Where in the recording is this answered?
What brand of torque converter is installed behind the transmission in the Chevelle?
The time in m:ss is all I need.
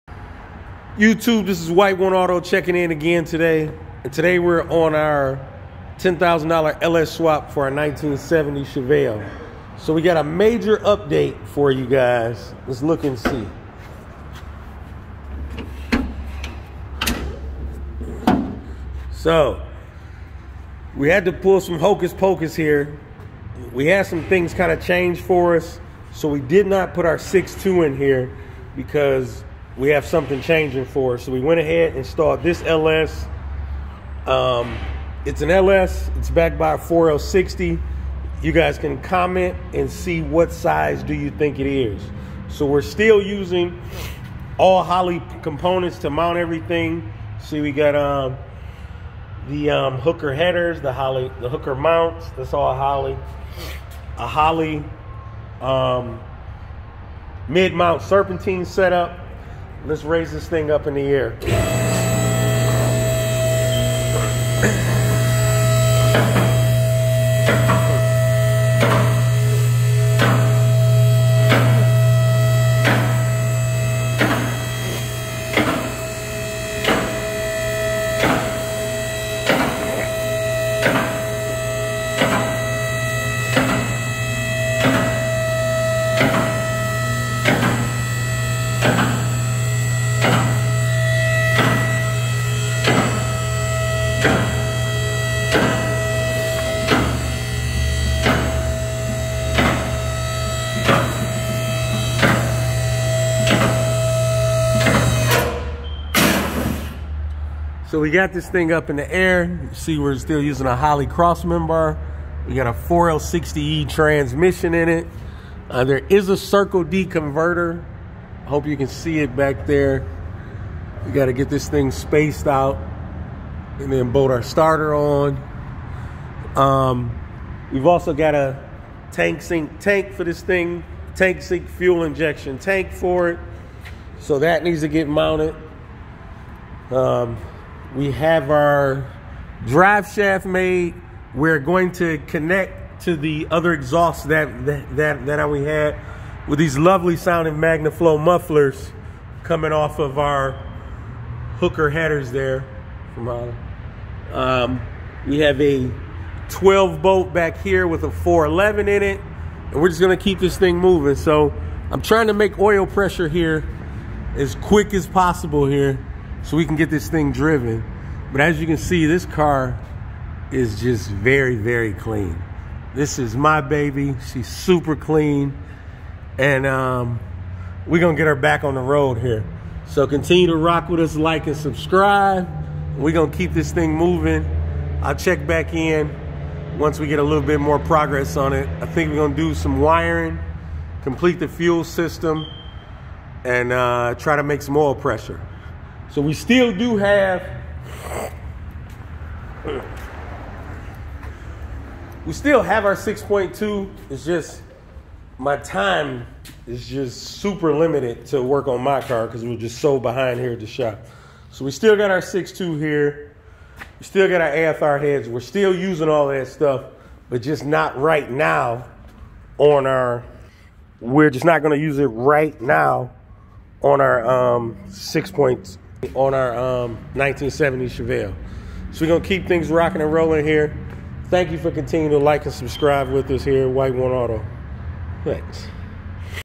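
1:56.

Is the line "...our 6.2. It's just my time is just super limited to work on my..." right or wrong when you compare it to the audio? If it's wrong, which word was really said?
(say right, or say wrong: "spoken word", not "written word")
right.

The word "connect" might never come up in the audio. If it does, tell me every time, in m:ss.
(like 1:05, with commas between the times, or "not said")
2:22.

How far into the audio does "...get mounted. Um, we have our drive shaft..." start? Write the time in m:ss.
2:14.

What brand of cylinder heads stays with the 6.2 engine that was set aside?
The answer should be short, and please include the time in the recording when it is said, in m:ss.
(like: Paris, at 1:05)
AFR, at 3:34.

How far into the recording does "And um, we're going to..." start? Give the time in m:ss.
2:56.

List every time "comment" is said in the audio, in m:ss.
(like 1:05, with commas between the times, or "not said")
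0:39.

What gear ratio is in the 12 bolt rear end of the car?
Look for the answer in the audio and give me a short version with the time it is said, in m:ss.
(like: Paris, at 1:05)
4.11, at 2:38.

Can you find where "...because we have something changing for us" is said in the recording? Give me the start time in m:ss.
0:28.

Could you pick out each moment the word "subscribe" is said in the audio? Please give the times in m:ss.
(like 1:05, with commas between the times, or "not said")
3:01, 3:52.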